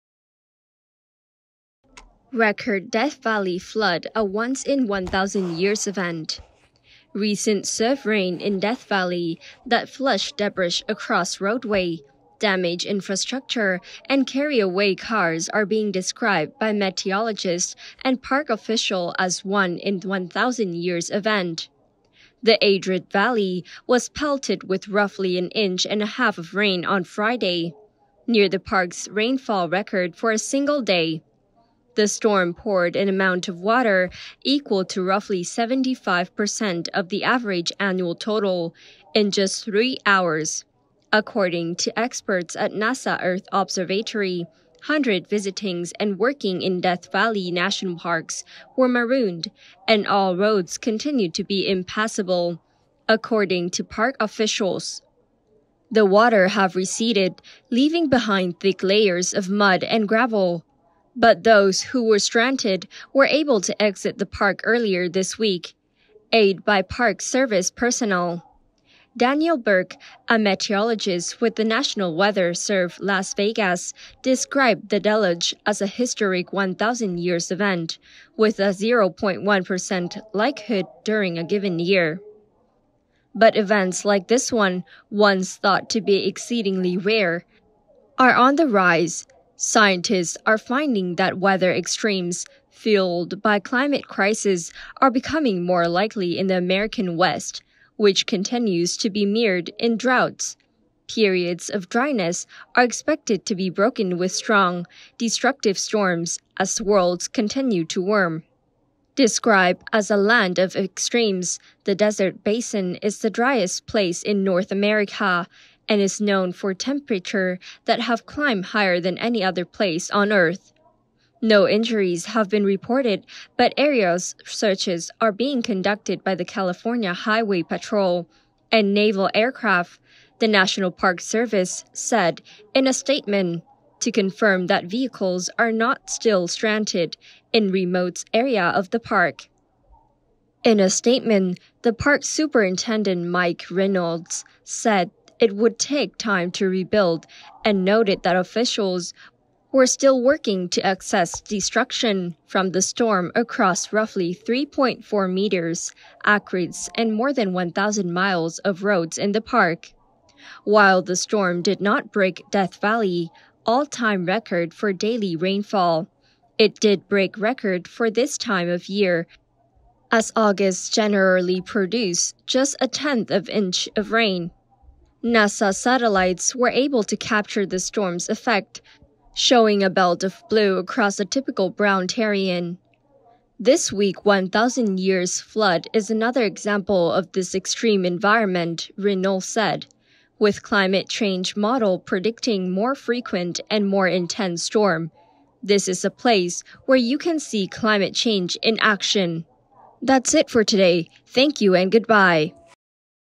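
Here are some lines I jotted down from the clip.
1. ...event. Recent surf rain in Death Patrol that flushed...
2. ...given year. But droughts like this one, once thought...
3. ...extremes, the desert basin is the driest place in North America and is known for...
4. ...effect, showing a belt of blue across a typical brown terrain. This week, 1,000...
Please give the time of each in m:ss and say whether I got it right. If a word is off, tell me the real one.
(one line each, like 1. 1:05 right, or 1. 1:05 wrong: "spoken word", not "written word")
1. 0:05 wrong: "Valley", not "Patrol"
2. 1:21 wrong: "events", not "droughts"
3. 1:50 right
4. 2:58 right.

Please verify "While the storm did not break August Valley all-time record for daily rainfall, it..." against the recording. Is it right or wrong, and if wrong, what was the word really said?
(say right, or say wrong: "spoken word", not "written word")
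wrong: "Death", not "August".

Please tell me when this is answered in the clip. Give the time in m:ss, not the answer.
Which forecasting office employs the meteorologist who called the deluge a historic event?
1:11.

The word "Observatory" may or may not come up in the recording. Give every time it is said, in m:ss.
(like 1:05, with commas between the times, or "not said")
0:43.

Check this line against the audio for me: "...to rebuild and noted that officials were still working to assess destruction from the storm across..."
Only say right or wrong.
right.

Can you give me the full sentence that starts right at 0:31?
The storm poured an amount of water equal to roughly 75% of the average annual total in just three hours.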